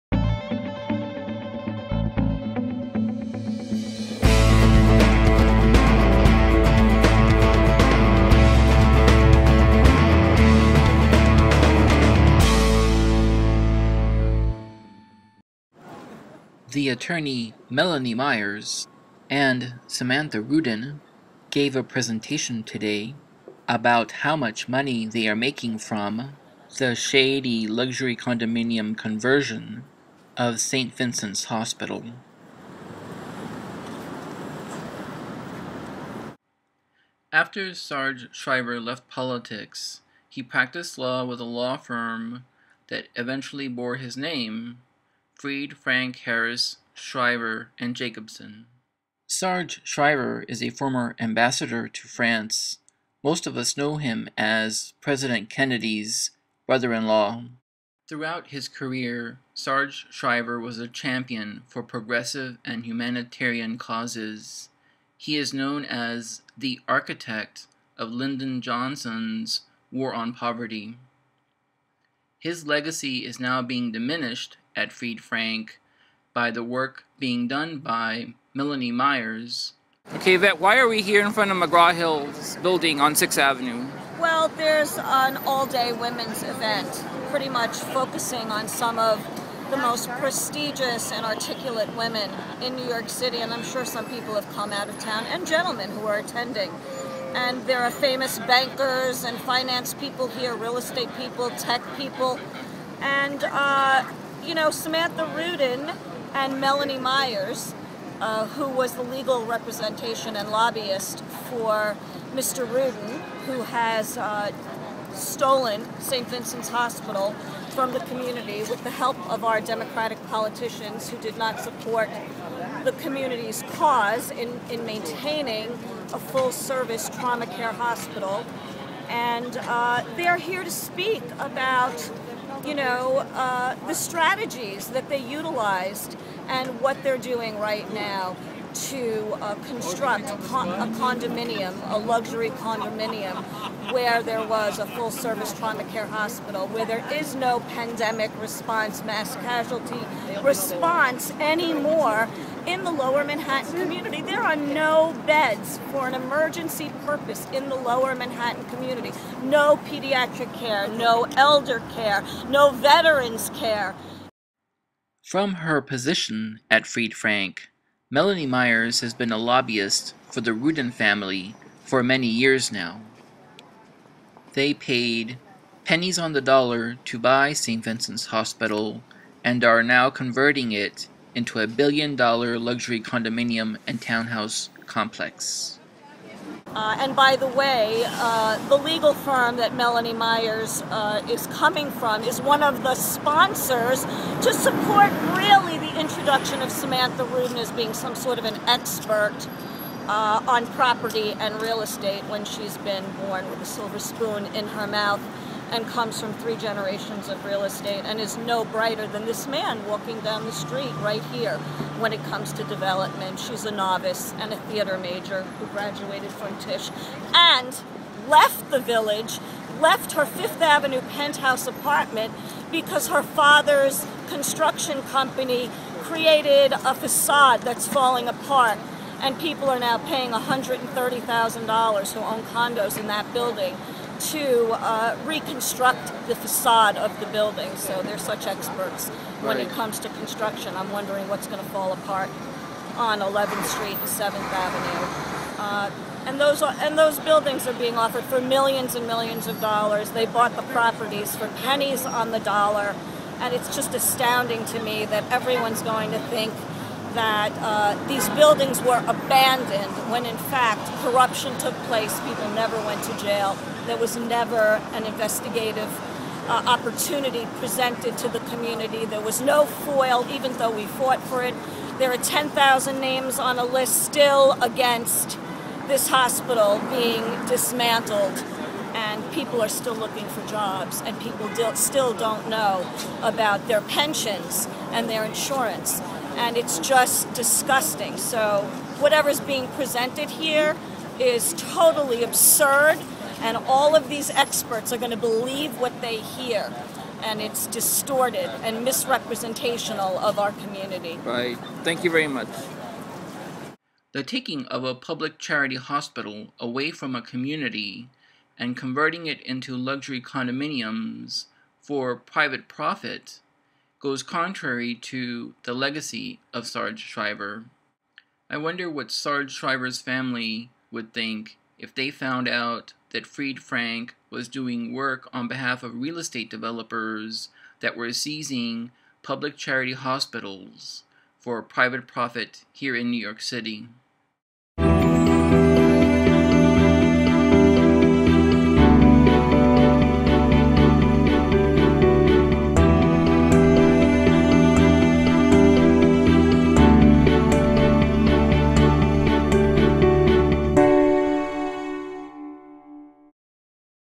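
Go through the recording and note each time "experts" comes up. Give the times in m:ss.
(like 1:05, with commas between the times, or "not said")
3:18, 3:58, 4:54.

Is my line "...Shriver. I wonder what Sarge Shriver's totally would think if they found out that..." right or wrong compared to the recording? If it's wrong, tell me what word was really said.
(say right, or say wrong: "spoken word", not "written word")
wrong: "family", not "totally".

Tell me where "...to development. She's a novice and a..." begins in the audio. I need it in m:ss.
3:32.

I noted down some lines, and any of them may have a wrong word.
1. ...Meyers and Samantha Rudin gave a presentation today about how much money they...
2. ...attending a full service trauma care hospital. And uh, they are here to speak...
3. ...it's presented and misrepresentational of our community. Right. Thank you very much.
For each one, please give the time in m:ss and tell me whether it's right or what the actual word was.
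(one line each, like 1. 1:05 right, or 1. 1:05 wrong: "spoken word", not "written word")
1. 0:18 right
2. 2:04 wrong: "maintaining", not "attending"
3. 4:57 wrong: "distorted", not "presented".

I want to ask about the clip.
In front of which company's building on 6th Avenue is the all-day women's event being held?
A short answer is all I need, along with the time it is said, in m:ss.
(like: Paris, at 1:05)
McGraw Hill, at 1:21.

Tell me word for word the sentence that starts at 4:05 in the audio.
Uh, and those are, and those buildings are being offered for millions and millions of dollars.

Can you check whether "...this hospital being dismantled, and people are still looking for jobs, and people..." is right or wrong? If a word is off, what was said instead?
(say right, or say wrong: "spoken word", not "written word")
right.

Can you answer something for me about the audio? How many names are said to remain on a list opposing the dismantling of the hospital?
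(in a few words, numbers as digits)
10,000.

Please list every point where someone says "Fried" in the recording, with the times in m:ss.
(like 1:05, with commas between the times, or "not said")
0:45, 1:14, 2:46, 5:23.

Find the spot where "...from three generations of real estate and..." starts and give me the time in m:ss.
3:26.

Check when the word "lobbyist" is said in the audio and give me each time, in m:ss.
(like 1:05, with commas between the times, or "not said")
1:50, 2:49.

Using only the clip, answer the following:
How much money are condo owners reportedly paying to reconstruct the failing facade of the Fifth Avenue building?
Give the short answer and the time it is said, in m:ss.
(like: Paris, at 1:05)
$130,000, at 3:50.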